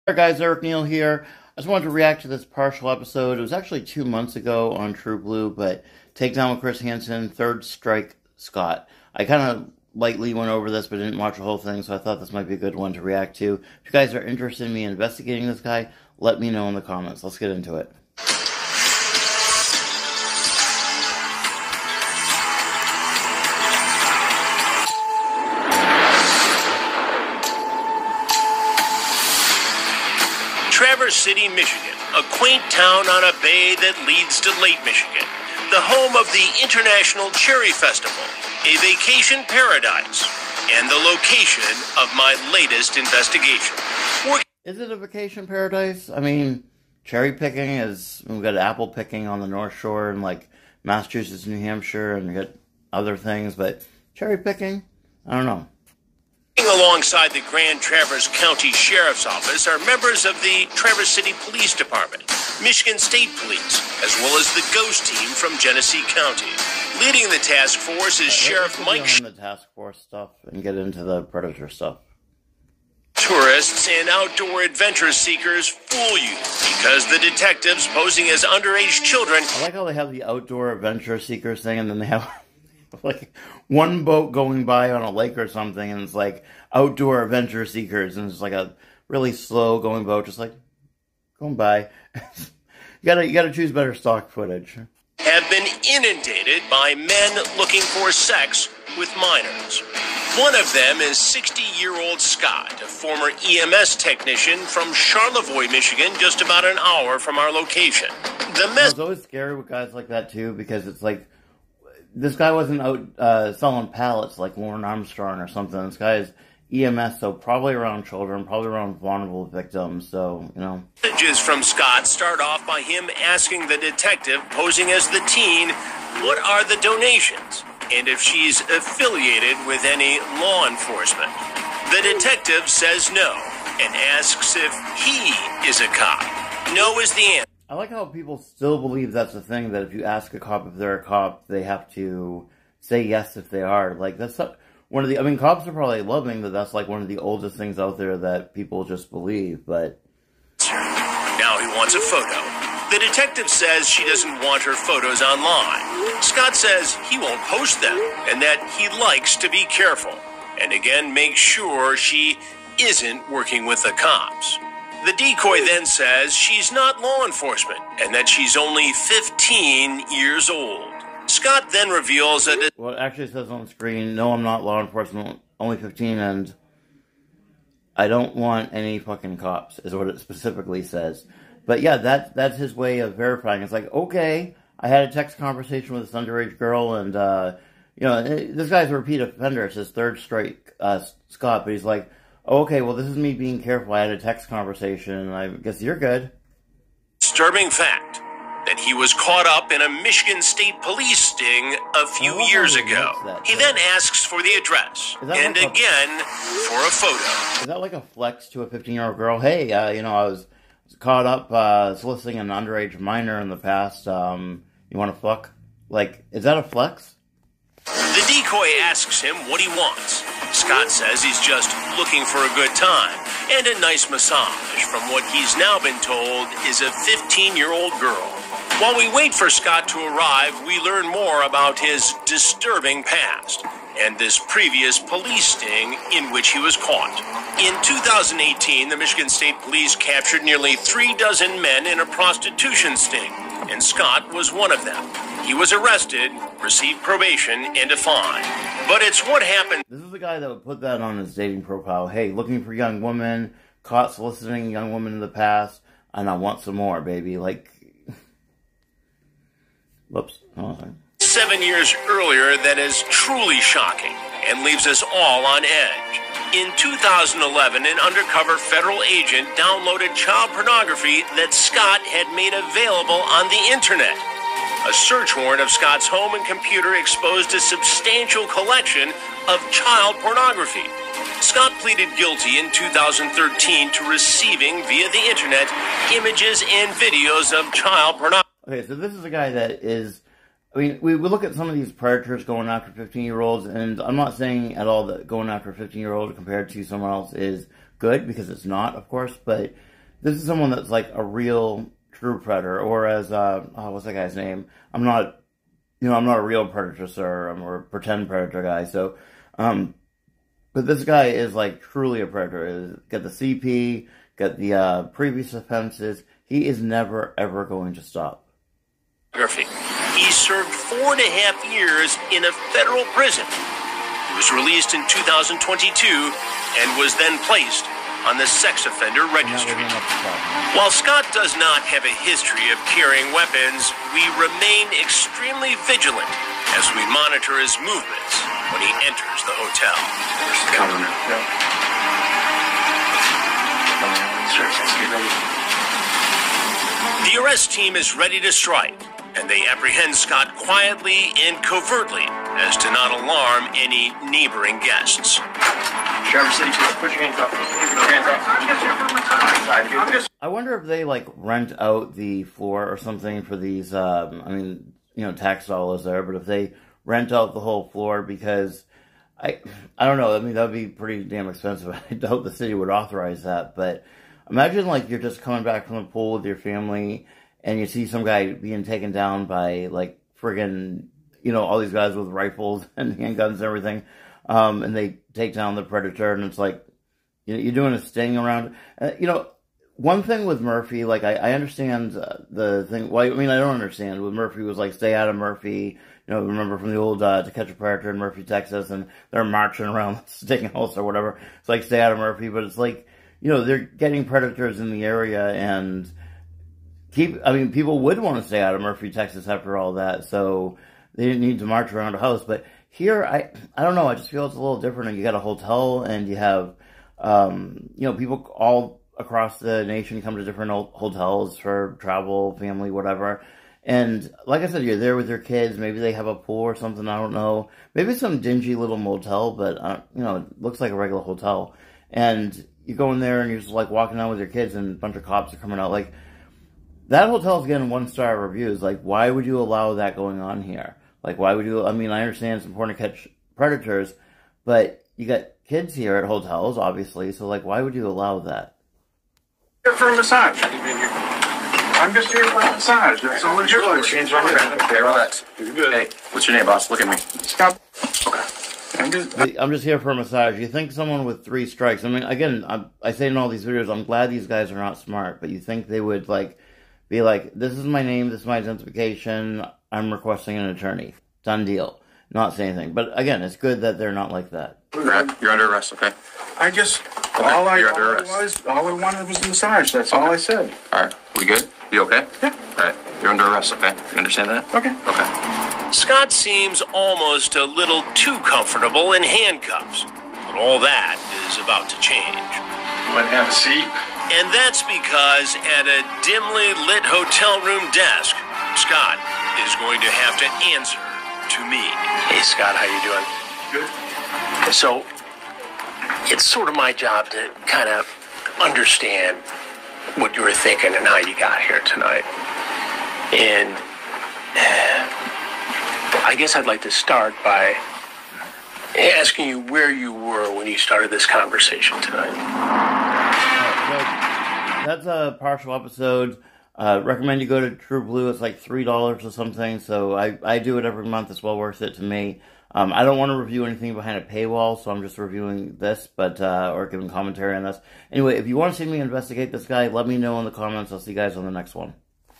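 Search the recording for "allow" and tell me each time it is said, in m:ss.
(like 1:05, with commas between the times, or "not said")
7:19, 7:28.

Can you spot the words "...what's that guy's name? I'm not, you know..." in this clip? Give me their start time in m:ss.
5:03.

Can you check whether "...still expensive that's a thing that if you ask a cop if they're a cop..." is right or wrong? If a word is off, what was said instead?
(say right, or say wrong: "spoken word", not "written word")
wrong: "believe", not "expensive".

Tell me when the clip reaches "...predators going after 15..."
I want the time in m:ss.
4:51.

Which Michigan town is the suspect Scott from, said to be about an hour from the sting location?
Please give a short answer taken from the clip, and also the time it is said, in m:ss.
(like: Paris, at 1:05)
Charlevoix, at 1:44.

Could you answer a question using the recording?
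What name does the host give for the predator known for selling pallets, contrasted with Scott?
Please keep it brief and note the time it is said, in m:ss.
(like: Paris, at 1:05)
Lauren Armstrong, at 1:54.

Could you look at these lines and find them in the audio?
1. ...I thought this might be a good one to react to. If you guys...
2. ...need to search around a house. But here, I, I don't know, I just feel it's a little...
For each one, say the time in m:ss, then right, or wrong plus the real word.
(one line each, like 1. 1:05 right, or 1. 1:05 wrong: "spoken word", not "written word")
1. 0:11 right
2. 6:51 wrong: "march", not "search".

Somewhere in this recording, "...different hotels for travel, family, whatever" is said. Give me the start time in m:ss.
7:00.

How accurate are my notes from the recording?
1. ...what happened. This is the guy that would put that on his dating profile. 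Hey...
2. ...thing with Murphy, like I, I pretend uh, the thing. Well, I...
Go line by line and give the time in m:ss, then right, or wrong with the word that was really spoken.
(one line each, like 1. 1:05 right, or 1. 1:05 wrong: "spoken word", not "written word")
1. 4:09 right
2. 6:30 wrong: "understand", not "pretend".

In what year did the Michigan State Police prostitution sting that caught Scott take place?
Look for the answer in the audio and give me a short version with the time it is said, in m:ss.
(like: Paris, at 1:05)
2018, at 3:57.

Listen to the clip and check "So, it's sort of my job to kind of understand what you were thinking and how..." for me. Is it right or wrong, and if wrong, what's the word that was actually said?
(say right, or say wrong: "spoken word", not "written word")
right.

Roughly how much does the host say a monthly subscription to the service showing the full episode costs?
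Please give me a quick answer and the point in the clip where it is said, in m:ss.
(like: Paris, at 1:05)
$3, at 8:48.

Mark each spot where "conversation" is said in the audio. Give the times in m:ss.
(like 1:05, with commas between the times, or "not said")
3:05, 3:14, 8:41.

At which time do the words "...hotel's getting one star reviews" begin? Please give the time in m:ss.
7:17.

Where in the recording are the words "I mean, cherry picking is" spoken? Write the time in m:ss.
0:46.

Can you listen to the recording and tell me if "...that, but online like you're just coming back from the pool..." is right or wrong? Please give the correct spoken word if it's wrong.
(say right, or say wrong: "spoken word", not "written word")
wrong: "imagine", not "online".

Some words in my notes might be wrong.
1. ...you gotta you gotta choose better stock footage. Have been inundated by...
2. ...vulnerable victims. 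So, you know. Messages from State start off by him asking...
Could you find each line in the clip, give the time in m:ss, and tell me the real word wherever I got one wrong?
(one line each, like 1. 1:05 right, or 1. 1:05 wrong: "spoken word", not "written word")
1. 1:32 right
2. 1:58 wrong: "Scott", not "State".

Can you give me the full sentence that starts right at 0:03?
It was actually two months ago on TruBlu, but Takedown with Chris Hansen, Third Strike Scott.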